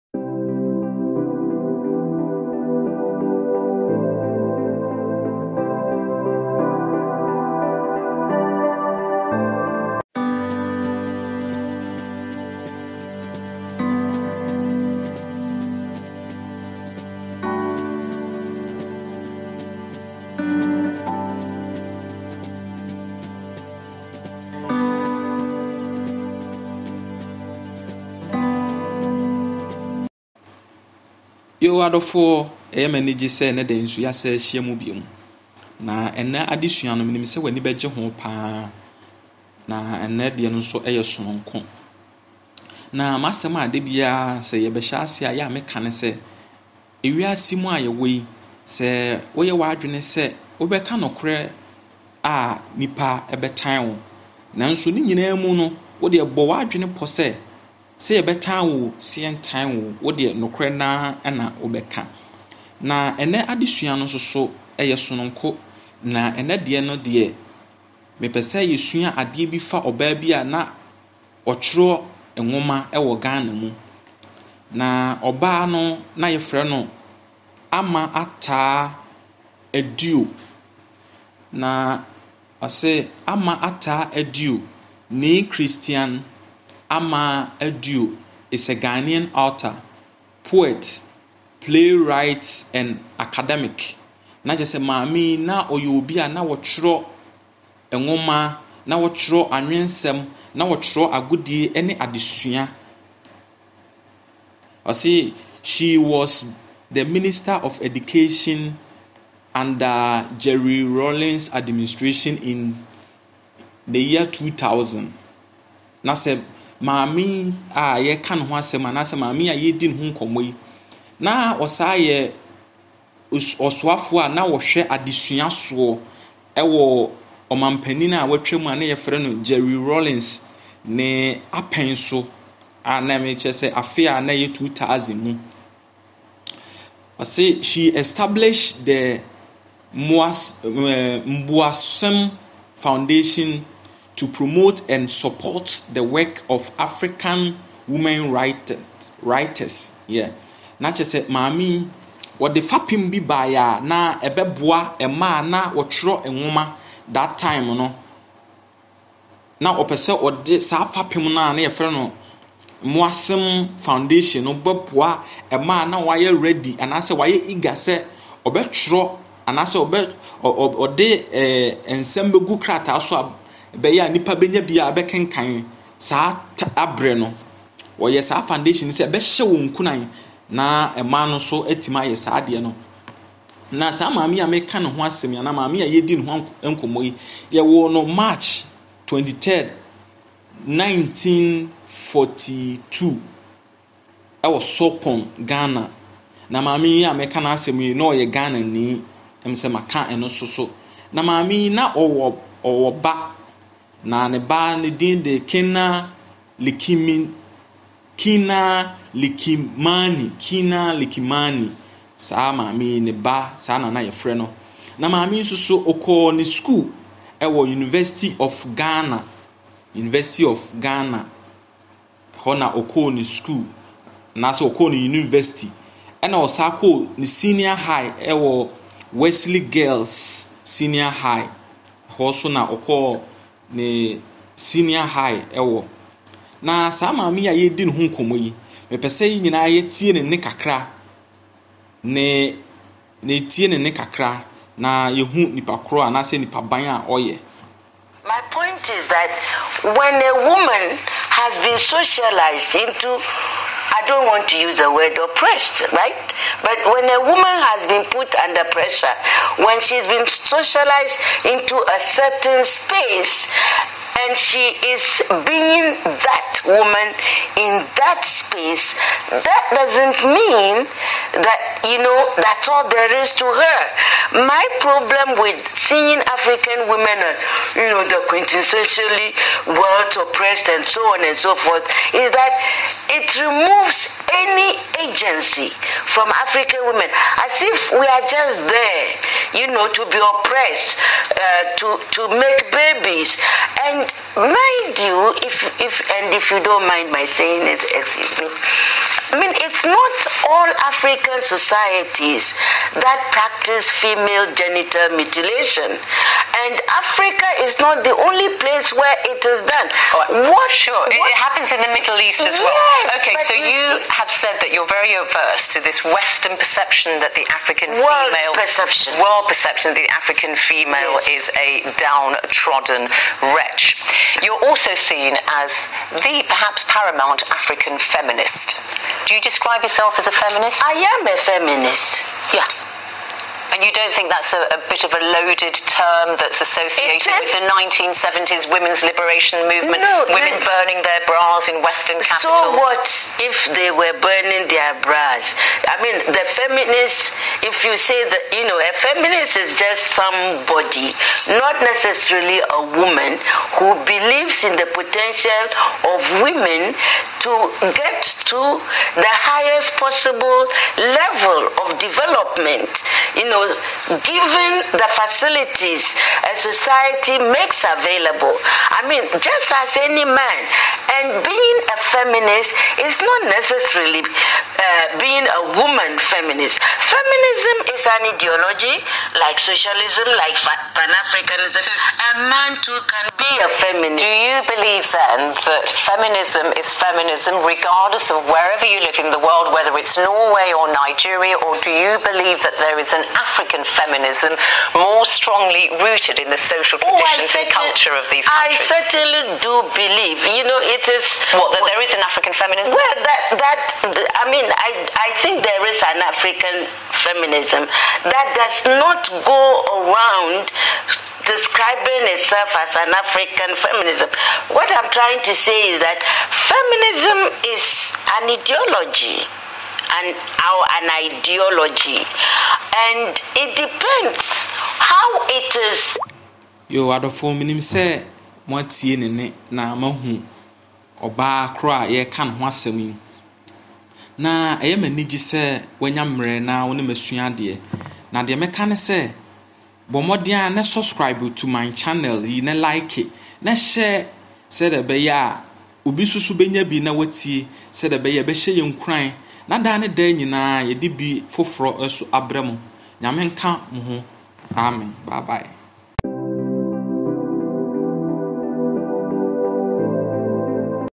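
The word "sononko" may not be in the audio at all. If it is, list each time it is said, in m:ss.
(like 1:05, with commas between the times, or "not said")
0:41, 1:05.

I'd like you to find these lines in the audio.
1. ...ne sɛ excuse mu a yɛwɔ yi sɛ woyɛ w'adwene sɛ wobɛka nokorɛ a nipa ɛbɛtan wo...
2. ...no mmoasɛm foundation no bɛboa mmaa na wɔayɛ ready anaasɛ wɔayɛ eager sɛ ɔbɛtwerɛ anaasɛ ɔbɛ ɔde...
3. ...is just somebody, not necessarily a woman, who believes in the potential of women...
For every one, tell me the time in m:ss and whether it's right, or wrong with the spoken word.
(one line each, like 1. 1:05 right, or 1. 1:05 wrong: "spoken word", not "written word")
1. 0:45 wrong: "ewiase", not "excuse"
2. 2:41 right
3. 5:49 right.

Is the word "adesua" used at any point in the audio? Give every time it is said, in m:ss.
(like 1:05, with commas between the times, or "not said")
0:36, 1:03, 1:41, 2:04.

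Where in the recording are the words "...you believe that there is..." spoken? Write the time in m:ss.
6:31.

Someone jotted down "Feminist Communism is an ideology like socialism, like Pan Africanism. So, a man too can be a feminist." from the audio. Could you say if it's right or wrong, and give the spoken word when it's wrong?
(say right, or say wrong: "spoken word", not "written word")
right.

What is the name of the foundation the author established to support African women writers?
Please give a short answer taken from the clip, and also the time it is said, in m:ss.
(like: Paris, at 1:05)
Mboasem Foundation, at 2:21.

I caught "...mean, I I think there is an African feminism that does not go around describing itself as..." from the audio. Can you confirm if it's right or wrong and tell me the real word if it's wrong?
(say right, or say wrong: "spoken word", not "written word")
right.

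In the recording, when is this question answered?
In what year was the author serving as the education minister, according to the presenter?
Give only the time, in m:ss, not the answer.
2:14.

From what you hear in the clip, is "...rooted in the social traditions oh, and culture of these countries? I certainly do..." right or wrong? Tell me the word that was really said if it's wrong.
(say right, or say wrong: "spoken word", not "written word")
right.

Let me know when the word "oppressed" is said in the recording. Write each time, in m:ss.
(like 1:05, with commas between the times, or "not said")
4:15, 4:40, 4:50.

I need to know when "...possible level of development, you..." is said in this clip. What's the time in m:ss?
6:00.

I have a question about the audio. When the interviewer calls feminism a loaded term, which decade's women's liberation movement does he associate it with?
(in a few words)
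1970s.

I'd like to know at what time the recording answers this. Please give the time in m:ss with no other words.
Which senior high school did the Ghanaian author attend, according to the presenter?
3:49.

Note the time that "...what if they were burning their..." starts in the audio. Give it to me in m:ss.
5:42.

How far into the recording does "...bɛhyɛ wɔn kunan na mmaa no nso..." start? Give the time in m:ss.
2:59.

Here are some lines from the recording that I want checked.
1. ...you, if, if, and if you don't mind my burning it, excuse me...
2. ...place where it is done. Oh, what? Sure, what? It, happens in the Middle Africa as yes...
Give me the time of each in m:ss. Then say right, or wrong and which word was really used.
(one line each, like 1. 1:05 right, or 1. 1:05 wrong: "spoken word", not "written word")
1. 4:54 wrong: "saying", not "burning"
2. 5:08 wrong: "East", not "Africa".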